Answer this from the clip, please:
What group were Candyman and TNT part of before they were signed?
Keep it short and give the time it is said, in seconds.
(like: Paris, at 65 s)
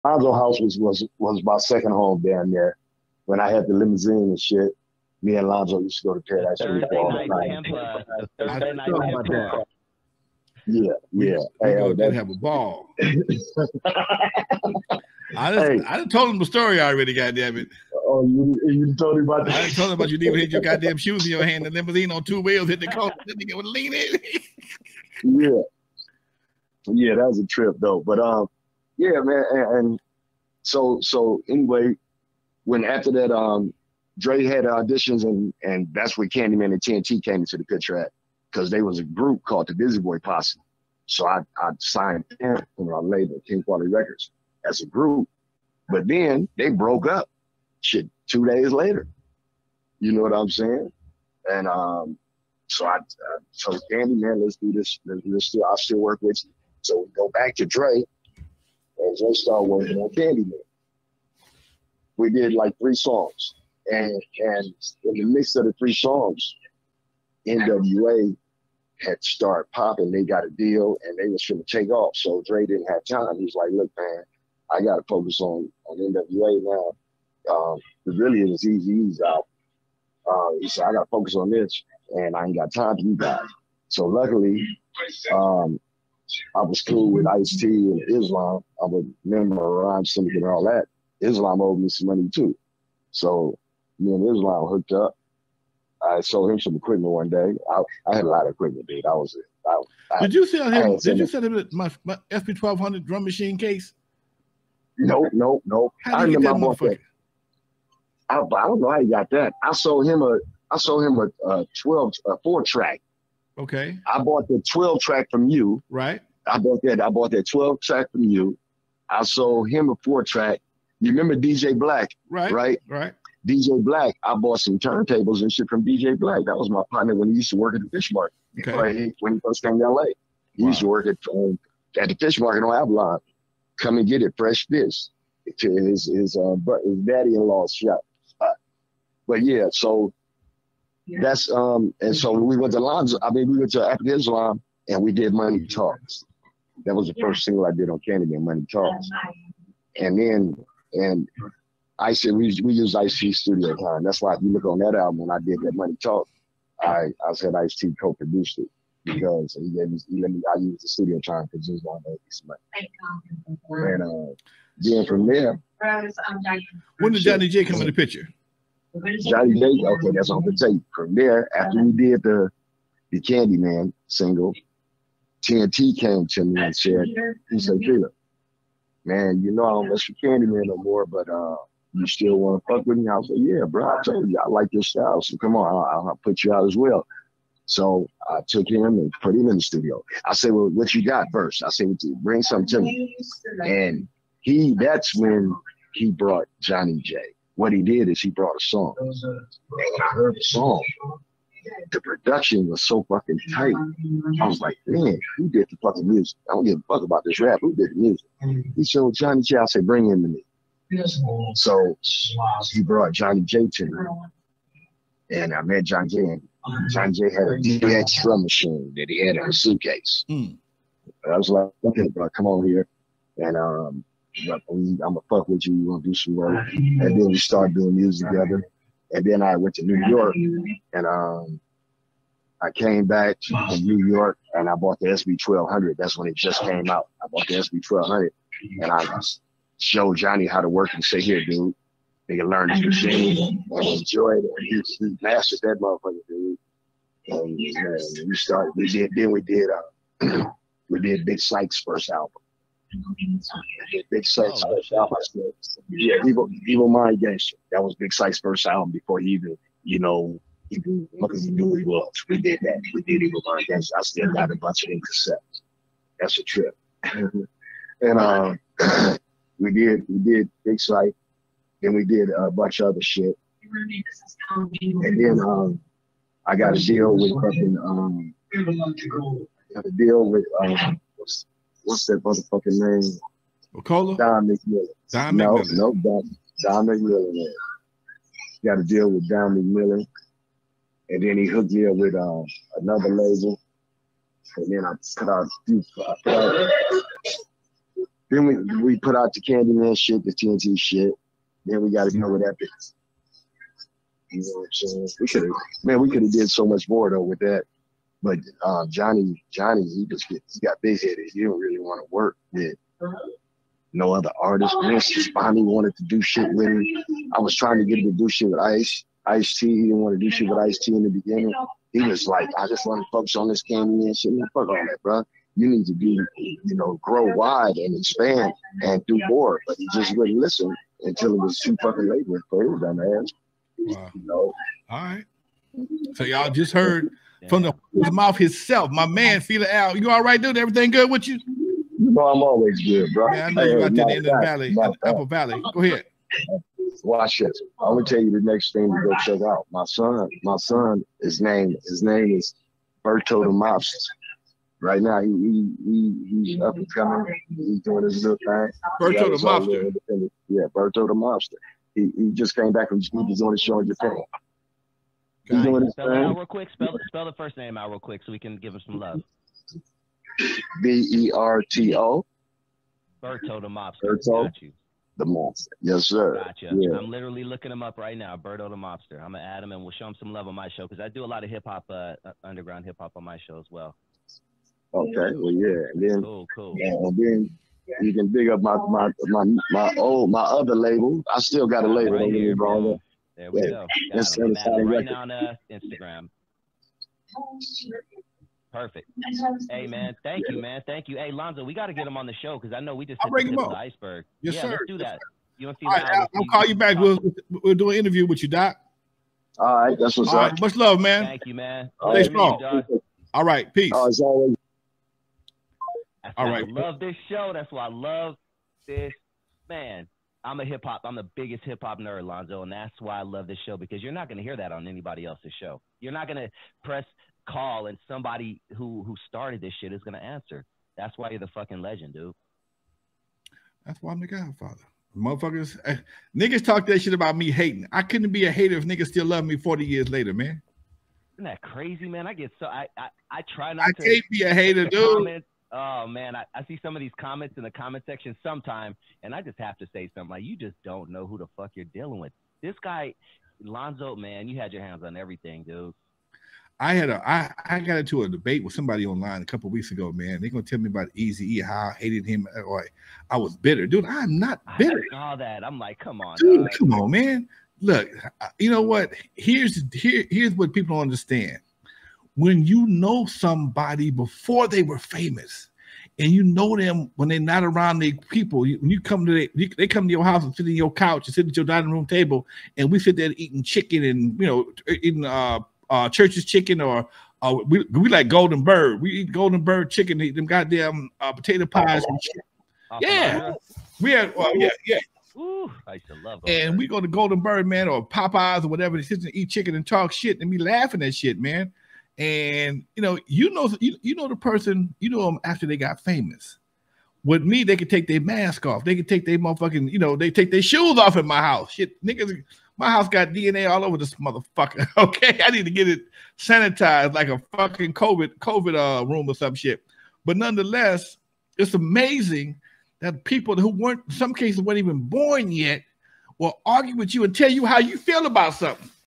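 Busy Boy Posse, at 39 s.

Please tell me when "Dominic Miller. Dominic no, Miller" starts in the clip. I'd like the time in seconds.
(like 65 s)
284 s.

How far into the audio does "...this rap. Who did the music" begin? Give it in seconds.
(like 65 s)
207 s.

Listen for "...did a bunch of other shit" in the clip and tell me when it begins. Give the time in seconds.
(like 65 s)
272 s.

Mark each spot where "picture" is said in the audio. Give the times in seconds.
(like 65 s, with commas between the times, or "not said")
37 s, 167 s.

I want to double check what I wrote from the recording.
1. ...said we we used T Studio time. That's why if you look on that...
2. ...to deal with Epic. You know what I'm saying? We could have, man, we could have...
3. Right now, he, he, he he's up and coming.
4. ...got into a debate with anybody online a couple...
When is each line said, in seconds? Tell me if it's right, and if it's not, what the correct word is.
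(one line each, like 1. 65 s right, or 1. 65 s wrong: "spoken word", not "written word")
1. 152 s right
2. 302 s right
3. 354 s right
4. 457 s wrong: "somebody", not "anybody".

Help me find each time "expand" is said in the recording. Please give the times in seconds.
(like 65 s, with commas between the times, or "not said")
327 s.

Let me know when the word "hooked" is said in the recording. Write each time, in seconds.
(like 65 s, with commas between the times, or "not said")
94 s, 291 s.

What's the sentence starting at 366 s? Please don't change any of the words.
Spell, spell the first name out real quick so we can give him some love.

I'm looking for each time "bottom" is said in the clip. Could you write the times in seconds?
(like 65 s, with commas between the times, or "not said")
not said.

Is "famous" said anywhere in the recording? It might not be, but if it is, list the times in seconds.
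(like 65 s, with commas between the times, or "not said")
474 s, 506 s.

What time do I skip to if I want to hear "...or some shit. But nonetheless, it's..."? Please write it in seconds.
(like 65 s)
519 s.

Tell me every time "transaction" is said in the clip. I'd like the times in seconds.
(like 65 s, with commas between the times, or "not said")
not said.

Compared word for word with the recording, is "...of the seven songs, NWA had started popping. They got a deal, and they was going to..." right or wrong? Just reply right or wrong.
wrong.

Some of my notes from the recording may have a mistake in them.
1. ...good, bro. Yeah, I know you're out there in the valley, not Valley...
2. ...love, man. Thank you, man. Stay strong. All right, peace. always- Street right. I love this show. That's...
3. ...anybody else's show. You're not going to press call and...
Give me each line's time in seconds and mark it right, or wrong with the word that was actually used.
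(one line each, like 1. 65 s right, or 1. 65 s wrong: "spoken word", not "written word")
1. 342 s wrong: "Apple", not "Valley"
2. 410 s wrong: "All", not "Street"
3. 424 s right.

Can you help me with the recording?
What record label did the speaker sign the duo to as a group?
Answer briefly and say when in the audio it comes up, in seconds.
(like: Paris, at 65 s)
King Quality Records, at 43 s.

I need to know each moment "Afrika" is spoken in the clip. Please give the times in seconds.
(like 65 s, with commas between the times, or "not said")
143 s.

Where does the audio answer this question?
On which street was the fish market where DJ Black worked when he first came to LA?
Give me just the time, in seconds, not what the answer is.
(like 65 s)
132 s.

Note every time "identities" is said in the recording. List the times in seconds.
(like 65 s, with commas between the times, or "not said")
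not said.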